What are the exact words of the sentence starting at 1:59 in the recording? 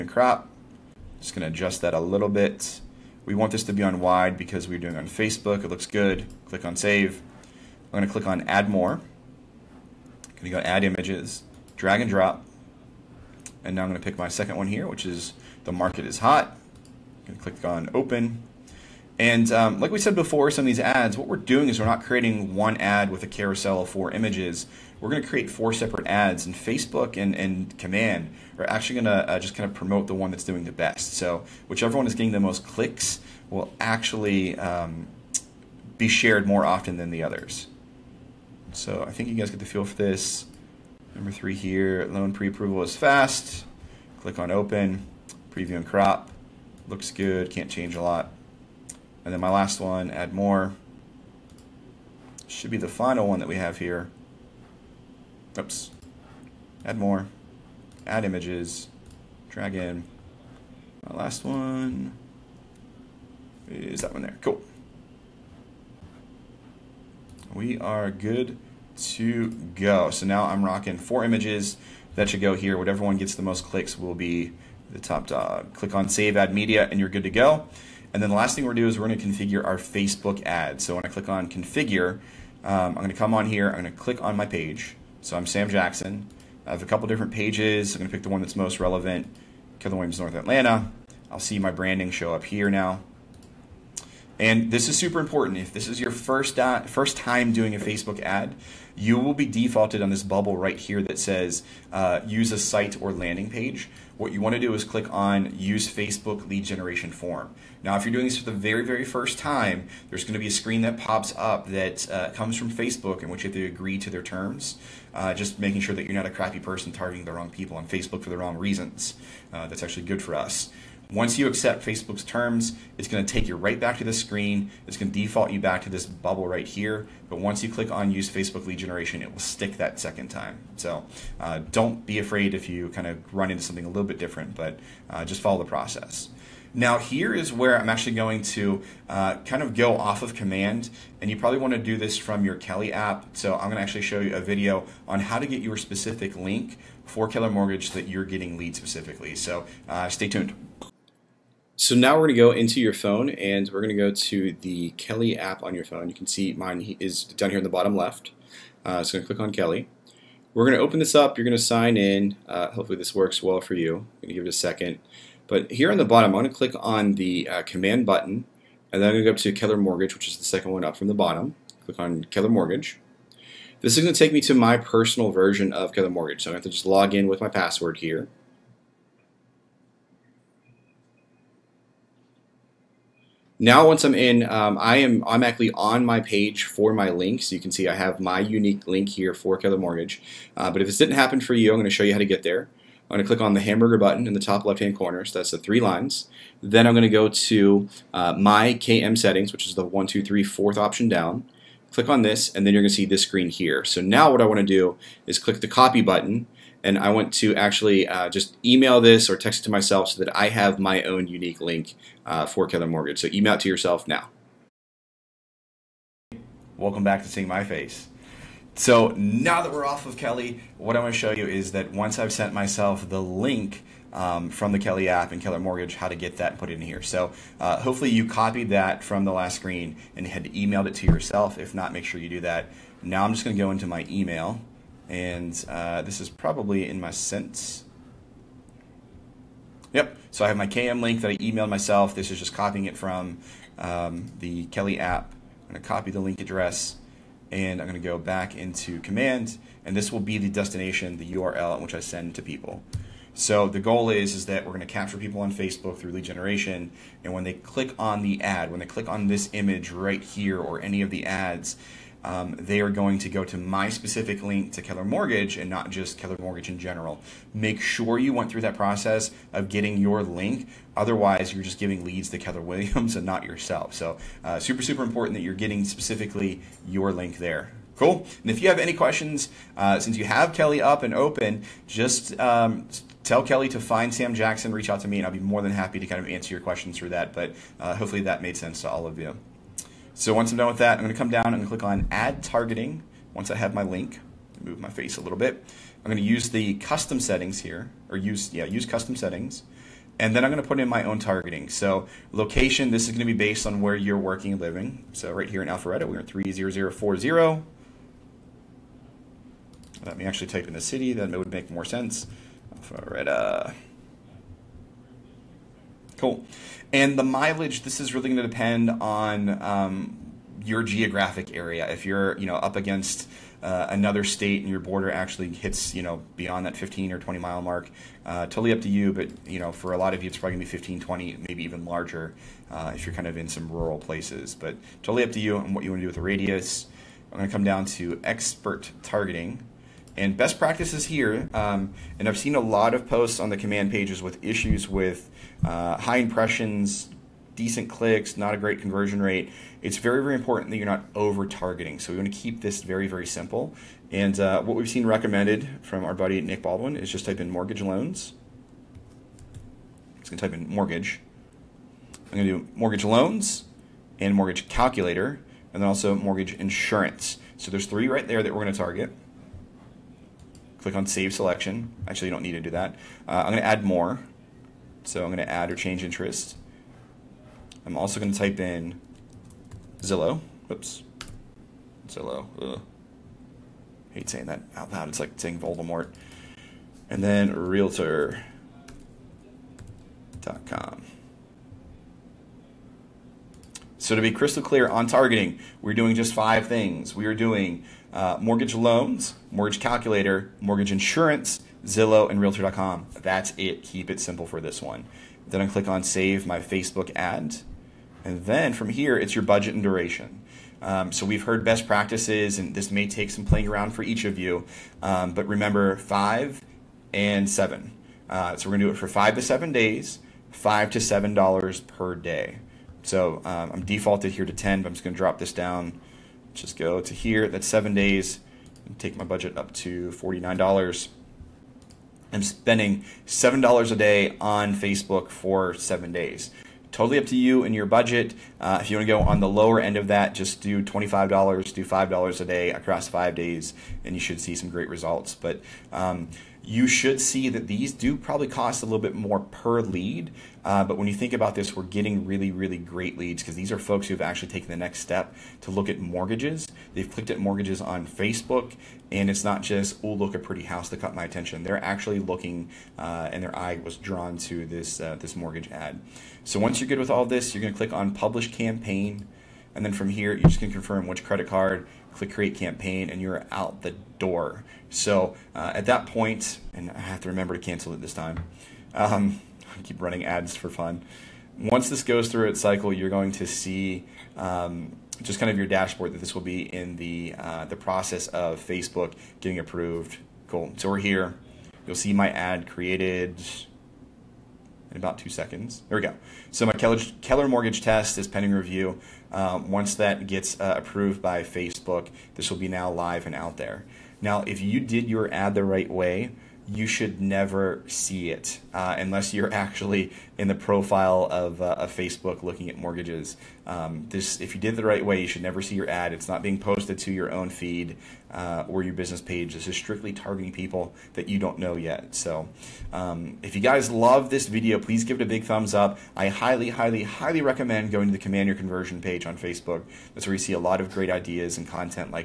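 Uh, that's actually good for us.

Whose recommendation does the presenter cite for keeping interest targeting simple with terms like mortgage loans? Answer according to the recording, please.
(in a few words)
Nick Baldwin.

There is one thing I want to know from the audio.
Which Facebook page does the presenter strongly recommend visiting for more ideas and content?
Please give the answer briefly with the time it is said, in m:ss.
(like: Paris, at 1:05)
Command Your Conversion, at 8:48.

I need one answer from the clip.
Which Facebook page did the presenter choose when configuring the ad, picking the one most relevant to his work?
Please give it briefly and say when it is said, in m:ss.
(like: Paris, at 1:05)
Keller Williams North Atlanta, at 1:29.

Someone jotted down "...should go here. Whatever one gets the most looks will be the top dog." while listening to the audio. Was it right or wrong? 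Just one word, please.
wrong.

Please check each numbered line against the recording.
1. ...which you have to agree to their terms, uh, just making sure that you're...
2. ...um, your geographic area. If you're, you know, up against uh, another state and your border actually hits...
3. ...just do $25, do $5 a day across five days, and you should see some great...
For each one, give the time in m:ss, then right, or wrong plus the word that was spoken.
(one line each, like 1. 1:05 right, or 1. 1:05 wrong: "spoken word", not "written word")
1. 1:53 right
2. 5:19 right
3. 7:20 right.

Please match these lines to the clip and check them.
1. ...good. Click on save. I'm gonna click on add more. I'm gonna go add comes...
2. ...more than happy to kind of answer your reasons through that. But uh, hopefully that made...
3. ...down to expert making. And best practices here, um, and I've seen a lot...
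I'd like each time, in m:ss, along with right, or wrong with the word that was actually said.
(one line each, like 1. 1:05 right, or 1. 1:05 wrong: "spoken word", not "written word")
1. 0:05 wrong: "images", not "comes"
2. 4:45 wrong: "questions", not "reasons"
3. 5:37 wrong: "targeting", not "making".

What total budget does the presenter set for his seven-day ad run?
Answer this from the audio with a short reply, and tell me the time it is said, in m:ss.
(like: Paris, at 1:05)
$49, at 7:10.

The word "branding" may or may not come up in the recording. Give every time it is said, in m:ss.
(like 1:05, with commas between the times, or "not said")
1:31.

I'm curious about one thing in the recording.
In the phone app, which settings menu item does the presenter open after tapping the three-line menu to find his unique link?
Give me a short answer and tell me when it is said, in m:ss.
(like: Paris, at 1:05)
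My KM Settings, at 3:18.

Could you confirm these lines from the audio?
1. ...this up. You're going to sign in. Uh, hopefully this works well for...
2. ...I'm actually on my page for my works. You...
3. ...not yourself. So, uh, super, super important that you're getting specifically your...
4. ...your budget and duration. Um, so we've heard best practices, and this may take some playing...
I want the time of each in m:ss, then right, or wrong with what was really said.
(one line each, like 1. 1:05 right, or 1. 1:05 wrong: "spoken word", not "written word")
1. 2:40 right
2. 3:05 wrong: "links", not "works"
3. 4:33 right
4. 6:49 right.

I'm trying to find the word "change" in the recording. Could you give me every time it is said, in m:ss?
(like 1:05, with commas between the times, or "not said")
0:47, 6:15.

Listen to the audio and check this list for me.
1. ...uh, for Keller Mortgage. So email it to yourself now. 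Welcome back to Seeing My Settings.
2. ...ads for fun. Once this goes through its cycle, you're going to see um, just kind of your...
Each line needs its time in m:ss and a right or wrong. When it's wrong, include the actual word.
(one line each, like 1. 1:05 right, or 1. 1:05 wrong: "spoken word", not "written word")
1. 3:32 wrong: "Face", not "Settings"
2. 8:00 right.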